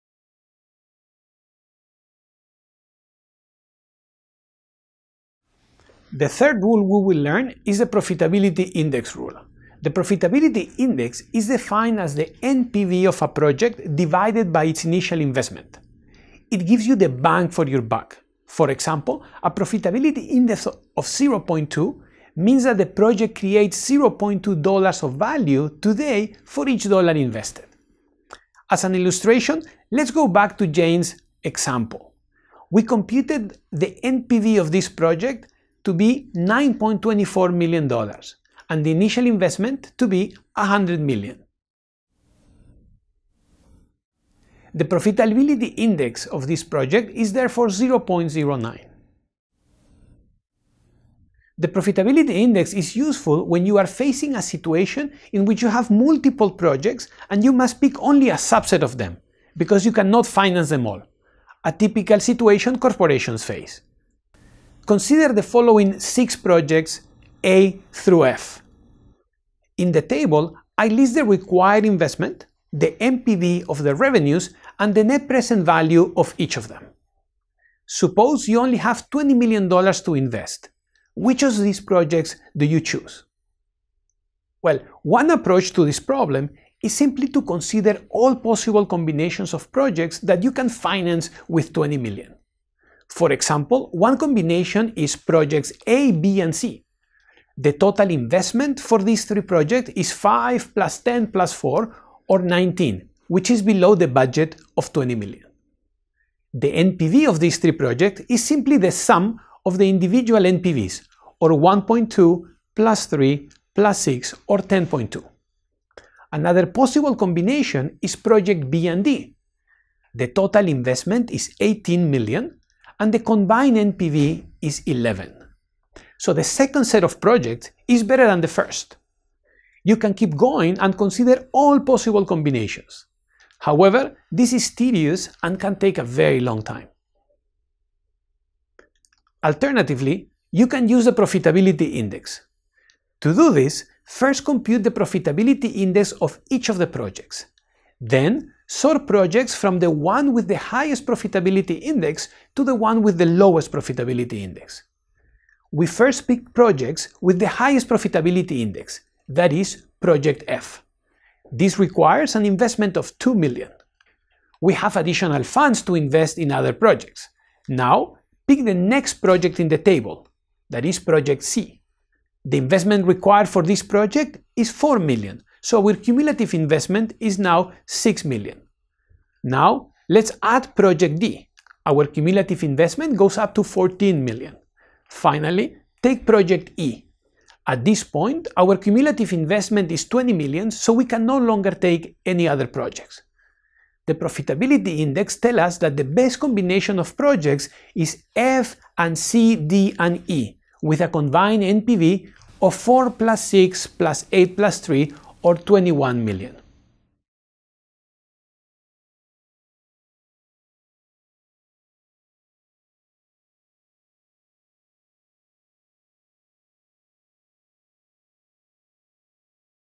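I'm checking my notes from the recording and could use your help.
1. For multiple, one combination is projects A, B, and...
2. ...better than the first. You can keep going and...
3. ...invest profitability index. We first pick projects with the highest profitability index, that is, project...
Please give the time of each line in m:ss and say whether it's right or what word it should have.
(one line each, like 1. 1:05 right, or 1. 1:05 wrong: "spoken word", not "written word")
1. 1:33 wrong: "example", not "multiple"
2. 2:08 right
3. 2:33 wrong: "lowest", not "invest".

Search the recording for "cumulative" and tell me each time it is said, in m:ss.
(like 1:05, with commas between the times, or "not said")
2:55, 3:02, 3:08.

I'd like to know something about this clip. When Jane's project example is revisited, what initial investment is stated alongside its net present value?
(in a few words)
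$100 million.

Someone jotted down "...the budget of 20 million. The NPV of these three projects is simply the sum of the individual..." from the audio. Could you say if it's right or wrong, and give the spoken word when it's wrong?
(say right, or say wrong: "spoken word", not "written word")
right.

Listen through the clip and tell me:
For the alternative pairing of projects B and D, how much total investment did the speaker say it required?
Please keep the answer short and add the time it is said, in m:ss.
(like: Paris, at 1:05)
18 million, at 2:01.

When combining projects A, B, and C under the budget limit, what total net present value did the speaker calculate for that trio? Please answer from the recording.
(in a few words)
10.2.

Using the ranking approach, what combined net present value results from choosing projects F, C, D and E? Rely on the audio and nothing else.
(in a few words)
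21 million.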